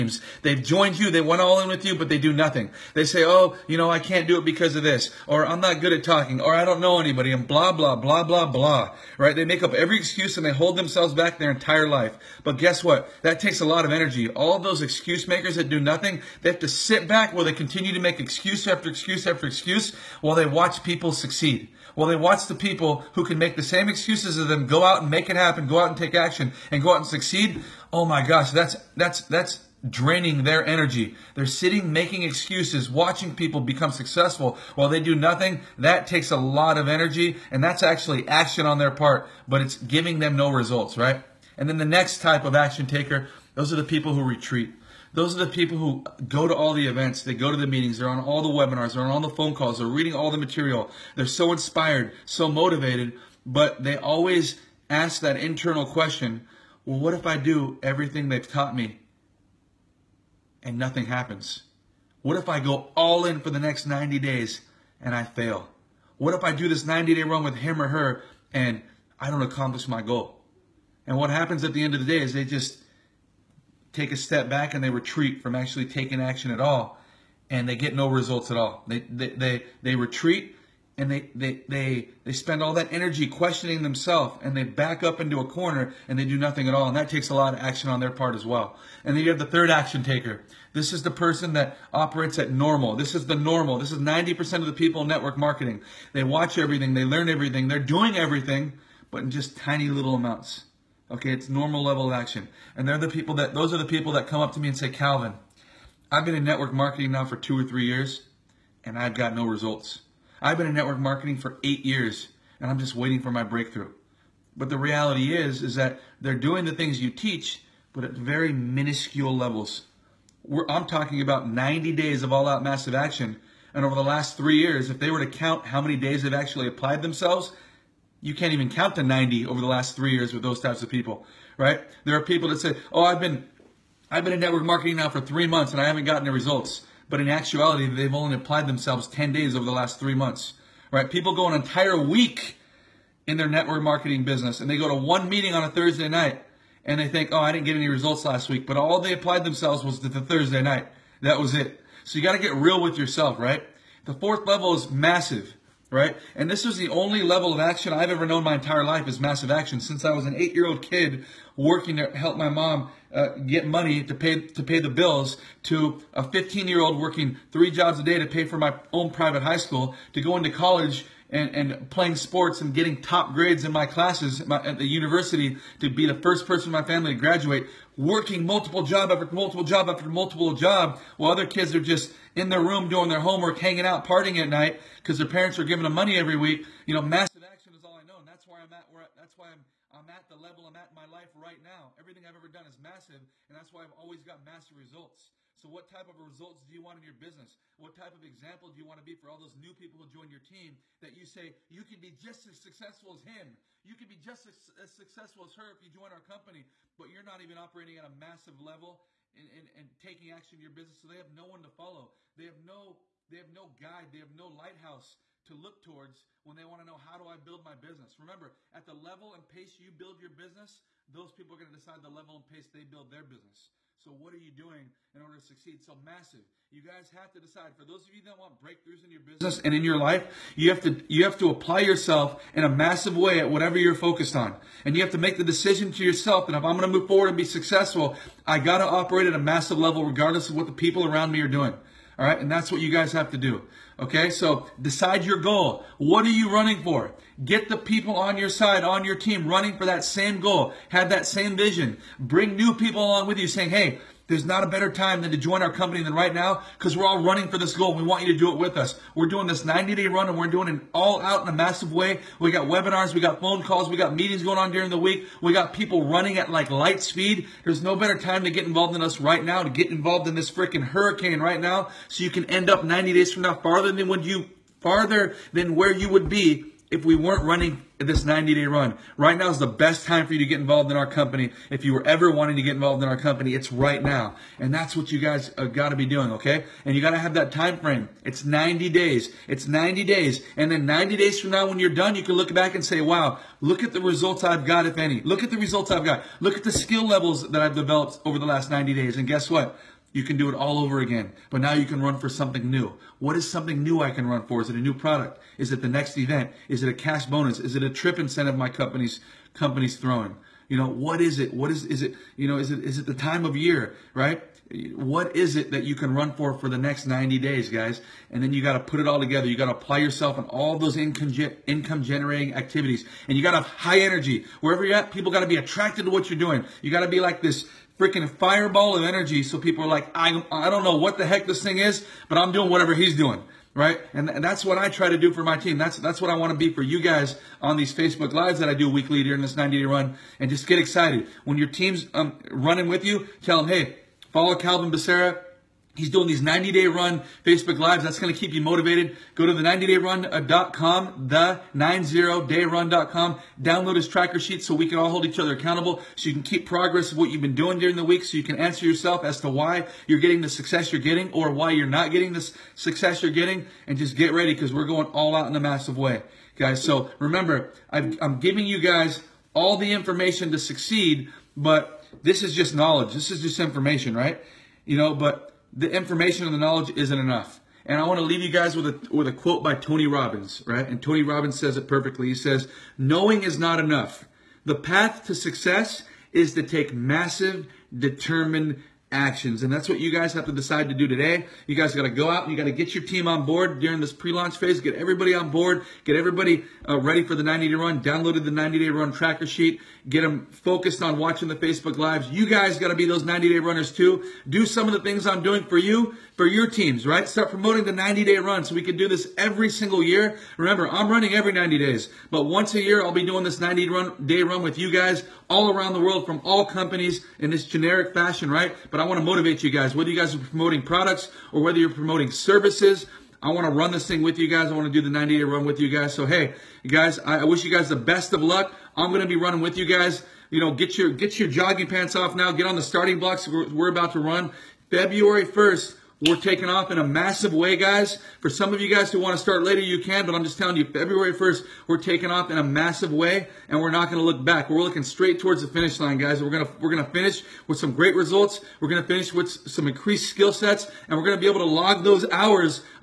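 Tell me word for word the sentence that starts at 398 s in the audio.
Downloaded the 90-day run tracker sheet.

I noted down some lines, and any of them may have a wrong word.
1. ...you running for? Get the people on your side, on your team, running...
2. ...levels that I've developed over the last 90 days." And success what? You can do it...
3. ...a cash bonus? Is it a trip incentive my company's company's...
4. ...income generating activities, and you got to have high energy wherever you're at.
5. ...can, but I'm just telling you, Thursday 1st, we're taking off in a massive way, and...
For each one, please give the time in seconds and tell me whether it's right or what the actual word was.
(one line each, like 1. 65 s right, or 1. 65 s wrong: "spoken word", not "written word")
1. 246 s right
2. 297 s wrong: "guess", not "success"
3. 306 s right
4. 321 s right
5. 440 s wrong: "February", not "Thursday".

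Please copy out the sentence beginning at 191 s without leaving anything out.
Everything I've ever done is massive, and that's why I've always got massive results.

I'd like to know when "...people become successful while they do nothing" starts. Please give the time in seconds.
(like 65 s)
33 s.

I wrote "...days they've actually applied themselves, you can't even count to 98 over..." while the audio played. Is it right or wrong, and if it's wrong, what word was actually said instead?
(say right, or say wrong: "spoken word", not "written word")
wrong: "90", not "98".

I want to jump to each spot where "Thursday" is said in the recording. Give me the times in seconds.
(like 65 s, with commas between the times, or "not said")
145 s, 150 s.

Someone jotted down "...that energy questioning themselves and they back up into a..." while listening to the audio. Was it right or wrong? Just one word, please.
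right.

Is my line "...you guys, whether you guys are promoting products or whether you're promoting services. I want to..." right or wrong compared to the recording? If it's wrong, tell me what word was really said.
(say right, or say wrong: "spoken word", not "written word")
right.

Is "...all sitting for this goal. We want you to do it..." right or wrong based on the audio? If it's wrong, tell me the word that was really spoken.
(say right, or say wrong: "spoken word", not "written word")
wrong: "running", not "sitting".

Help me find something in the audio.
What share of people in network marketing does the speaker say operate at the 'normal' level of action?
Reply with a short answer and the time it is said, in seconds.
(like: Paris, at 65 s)
90%, at 93 s.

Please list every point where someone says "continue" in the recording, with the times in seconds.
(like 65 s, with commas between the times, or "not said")
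17 s.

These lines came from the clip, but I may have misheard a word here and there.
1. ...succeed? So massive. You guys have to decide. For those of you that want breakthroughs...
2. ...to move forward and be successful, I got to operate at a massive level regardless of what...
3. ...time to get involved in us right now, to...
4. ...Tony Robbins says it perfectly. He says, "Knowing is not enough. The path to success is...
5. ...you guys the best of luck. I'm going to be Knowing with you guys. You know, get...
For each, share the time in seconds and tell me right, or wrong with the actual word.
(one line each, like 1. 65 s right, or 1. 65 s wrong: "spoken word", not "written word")
1. 225 s right
2. 236 s right
3. 268 s right
4. 381 s right
5. 427 s wrong: "running", not "Knowing".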